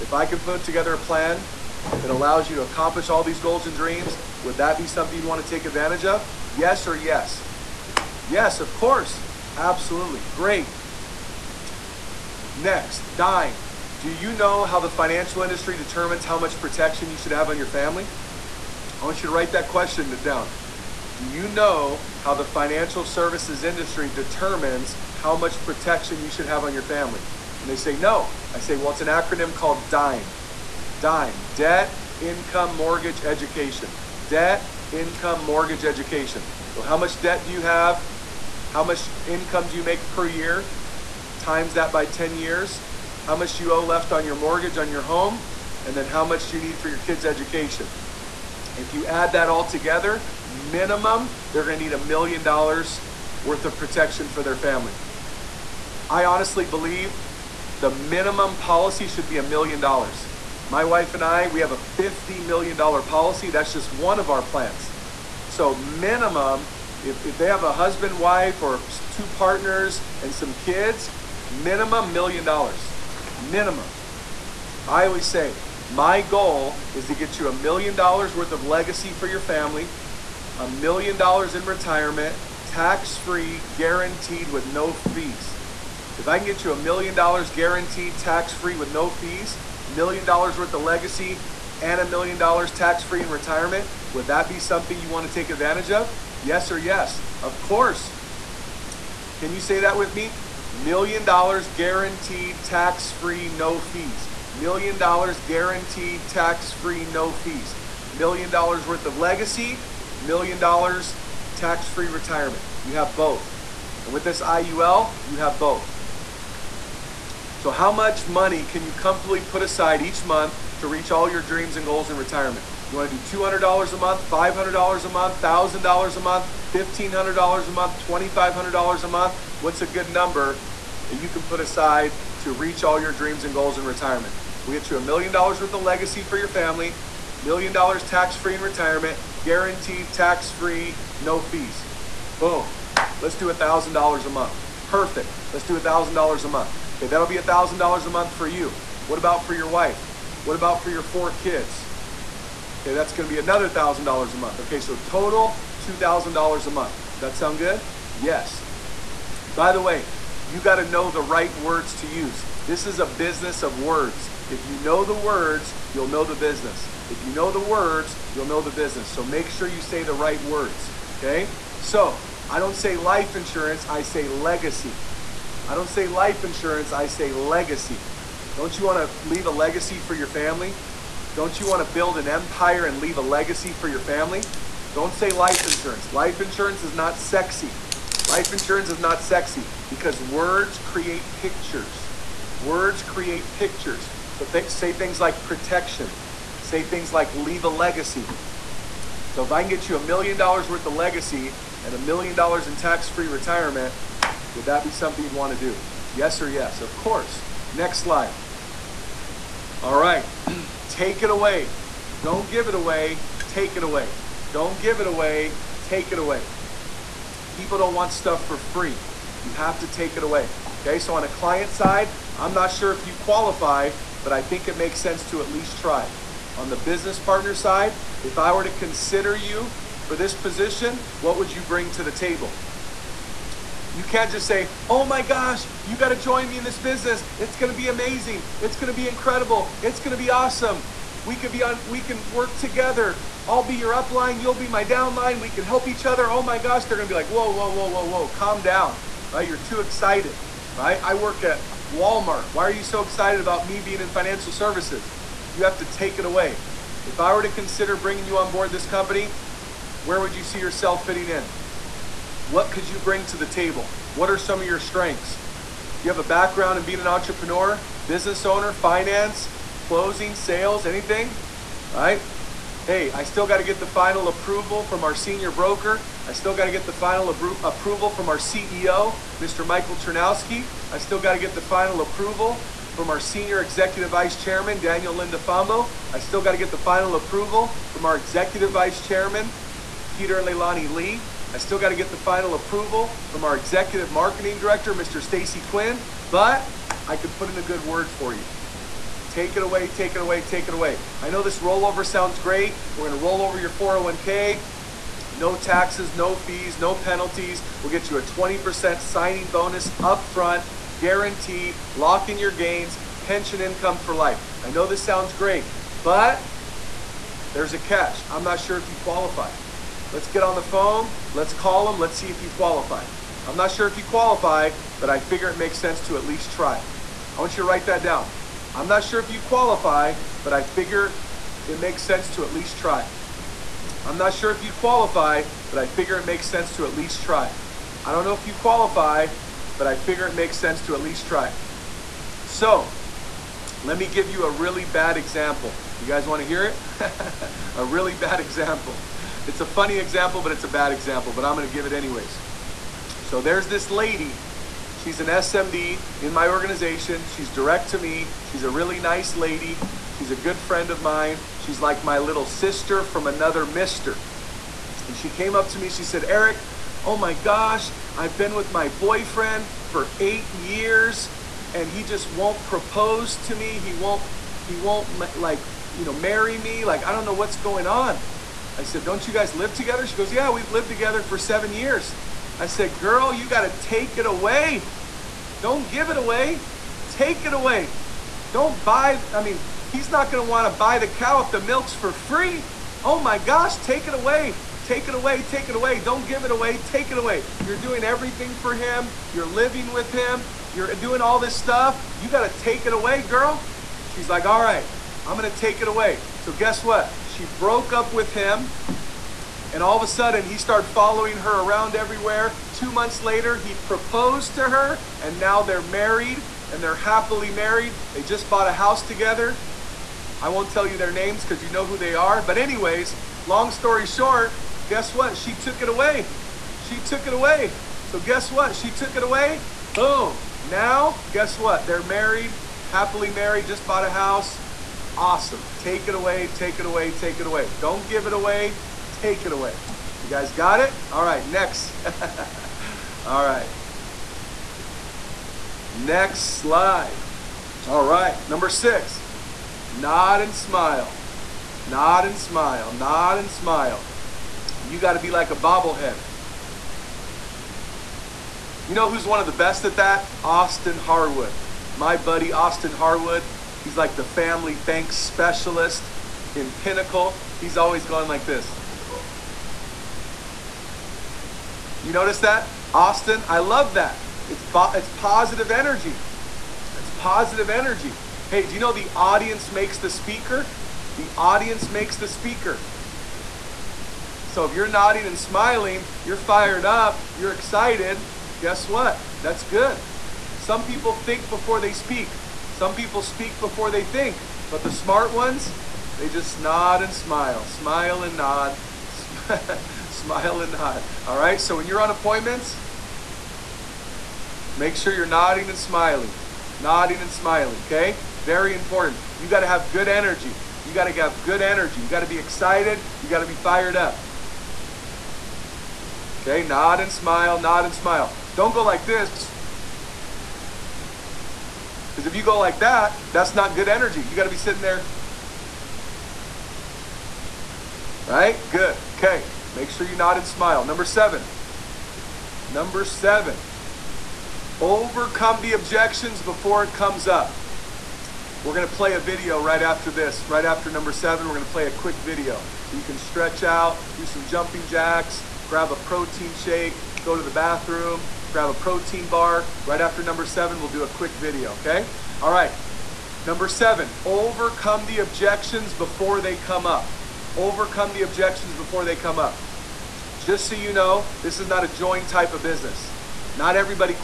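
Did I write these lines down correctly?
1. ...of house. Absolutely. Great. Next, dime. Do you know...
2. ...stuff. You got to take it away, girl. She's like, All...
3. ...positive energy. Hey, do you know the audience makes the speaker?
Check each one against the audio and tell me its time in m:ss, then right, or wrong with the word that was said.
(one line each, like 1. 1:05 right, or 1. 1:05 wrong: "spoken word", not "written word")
1. 0:08 wrong: "course", not "house"
2. 6:41 right
3. 7:57 right.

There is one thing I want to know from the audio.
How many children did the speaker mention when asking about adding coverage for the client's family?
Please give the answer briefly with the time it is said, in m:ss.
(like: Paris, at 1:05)
4, at 2:31.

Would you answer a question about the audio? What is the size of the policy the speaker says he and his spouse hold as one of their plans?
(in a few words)
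$50 million.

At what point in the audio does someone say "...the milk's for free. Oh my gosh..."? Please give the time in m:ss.
6:31.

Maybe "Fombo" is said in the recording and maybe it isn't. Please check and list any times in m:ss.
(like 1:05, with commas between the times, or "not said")
4:45.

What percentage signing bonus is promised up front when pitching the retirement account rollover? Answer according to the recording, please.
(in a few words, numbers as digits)
20%.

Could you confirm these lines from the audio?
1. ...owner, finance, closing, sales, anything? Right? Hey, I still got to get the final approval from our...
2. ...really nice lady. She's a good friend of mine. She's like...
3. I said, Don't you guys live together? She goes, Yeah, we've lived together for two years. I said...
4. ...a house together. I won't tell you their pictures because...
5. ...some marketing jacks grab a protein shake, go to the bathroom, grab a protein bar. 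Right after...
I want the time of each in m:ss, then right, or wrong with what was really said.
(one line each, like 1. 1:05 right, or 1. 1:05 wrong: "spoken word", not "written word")
1. 4:28 right
2. 5:58 right
3. 6:18 wrong: "seven", not "two"
4. 6:58 wrong: "names", not "pictures"
5. 9:04 wrong: "jumping", not "marketing".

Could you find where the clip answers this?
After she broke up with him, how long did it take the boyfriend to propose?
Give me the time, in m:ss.
6:52.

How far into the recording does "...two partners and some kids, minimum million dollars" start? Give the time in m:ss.
1:09.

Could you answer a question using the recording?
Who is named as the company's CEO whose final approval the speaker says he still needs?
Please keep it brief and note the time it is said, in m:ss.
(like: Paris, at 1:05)
Michael Chernowski, at 4:39.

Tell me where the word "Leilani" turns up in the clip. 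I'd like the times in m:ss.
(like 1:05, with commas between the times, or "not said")
4:50.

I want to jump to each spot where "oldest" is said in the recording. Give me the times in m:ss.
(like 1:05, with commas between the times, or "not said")
not said.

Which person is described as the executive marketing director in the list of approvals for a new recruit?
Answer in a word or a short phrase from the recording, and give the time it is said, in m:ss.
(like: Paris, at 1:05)
Stacy Quinn, at 4:55.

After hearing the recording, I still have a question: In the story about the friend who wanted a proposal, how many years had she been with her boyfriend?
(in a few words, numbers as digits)
8 years.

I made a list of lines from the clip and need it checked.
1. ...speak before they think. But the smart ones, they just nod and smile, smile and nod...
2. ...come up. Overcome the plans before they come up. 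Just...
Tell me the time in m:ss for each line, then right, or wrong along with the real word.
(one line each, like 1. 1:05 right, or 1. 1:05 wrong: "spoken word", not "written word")
1. 8:13 right
2. 9:16 wrong: "objections", not "plans".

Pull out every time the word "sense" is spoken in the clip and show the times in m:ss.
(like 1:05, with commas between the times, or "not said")
3:45, 5:25, 5:32, 5:36, 5:40.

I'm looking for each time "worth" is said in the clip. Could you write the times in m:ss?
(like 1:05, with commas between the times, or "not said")
0:53, 1:18, 1:30, 1:48, 2:15, 3:20.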